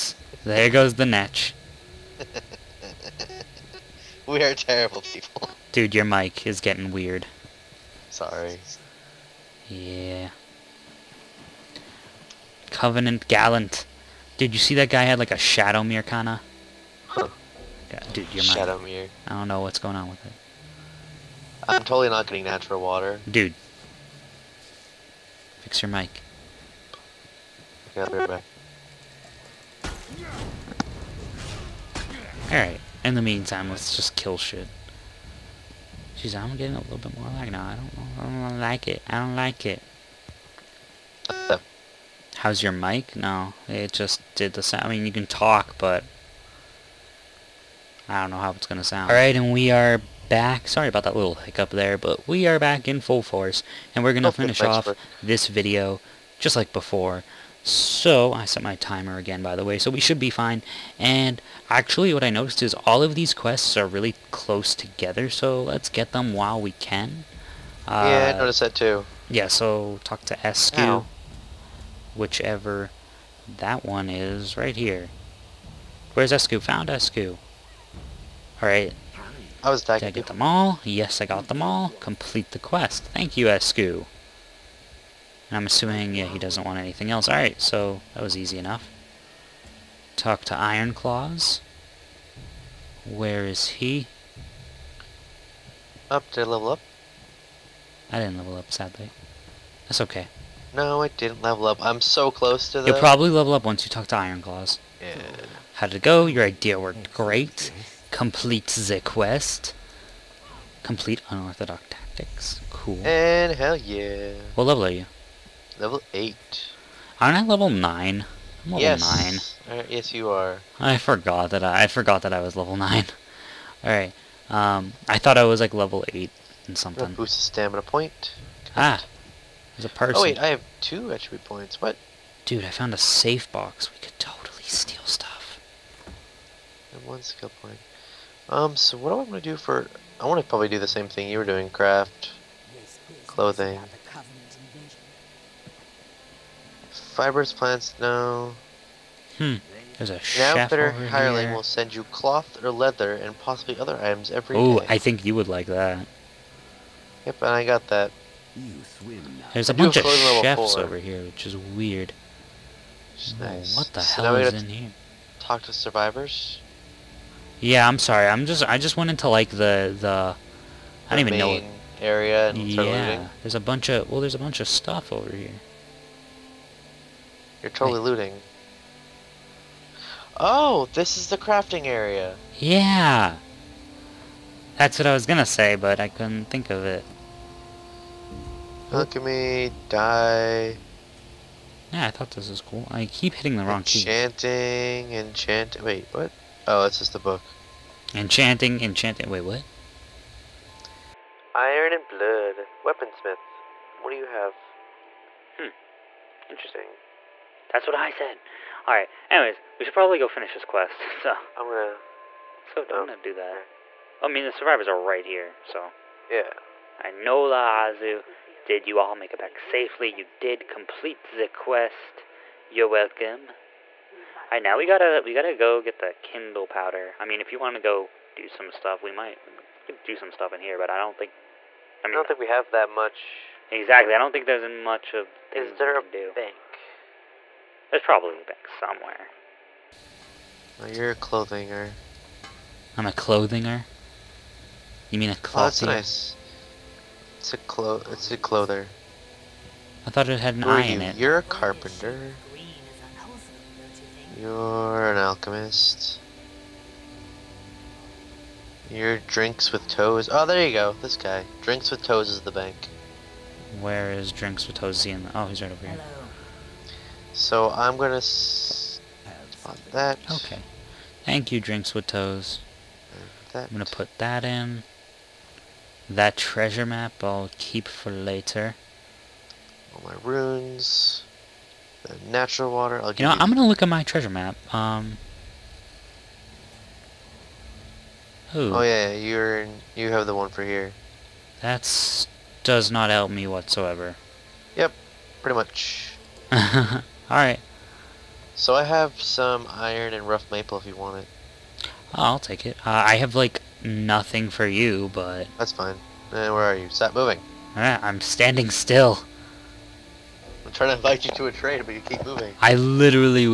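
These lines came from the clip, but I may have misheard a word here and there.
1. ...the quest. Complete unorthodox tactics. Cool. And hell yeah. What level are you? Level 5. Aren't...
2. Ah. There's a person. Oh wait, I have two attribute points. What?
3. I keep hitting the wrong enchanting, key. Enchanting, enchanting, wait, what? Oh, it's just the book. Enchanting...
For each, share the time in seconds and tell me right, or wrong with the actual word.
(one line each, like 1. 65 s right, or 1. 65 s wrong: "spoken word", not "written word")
1. 108 s wrong: "8", not "5"
2. 128 s right
3. 192 s right.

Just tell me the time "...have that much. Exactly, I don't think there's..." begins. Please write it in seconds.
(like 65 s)
232 s.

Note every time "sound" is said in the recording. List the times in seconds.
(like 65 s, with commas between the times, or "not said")
44 s, 48 s.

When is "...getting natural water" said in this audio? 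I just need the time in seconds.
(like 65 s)
22 s.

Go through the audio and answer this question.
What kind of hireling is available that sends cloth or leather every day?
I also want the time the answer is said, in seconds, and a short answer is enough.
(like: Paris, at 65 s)
Outfitter, at 150 s.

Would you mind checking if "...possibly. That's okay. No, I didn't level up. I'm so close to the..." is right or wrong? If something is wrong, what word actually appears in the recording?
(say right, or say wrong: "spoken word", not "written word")
wrong: "sadly", not "possibly".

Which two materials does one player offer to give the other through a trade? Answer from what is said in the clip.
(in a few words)
Iron and rough maple.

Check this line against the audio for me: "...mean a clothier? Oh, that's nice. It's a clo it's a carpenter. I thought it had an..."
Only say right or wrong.
wrong.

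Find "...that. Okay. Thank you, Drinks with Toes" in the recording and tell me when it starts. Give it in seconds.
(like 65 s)
269 s.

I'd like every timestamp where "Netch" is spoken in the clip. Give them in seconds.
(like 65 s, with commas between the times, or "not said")
1 s.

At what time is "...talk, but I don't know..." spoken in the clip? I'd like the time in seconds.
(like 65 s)
45 s.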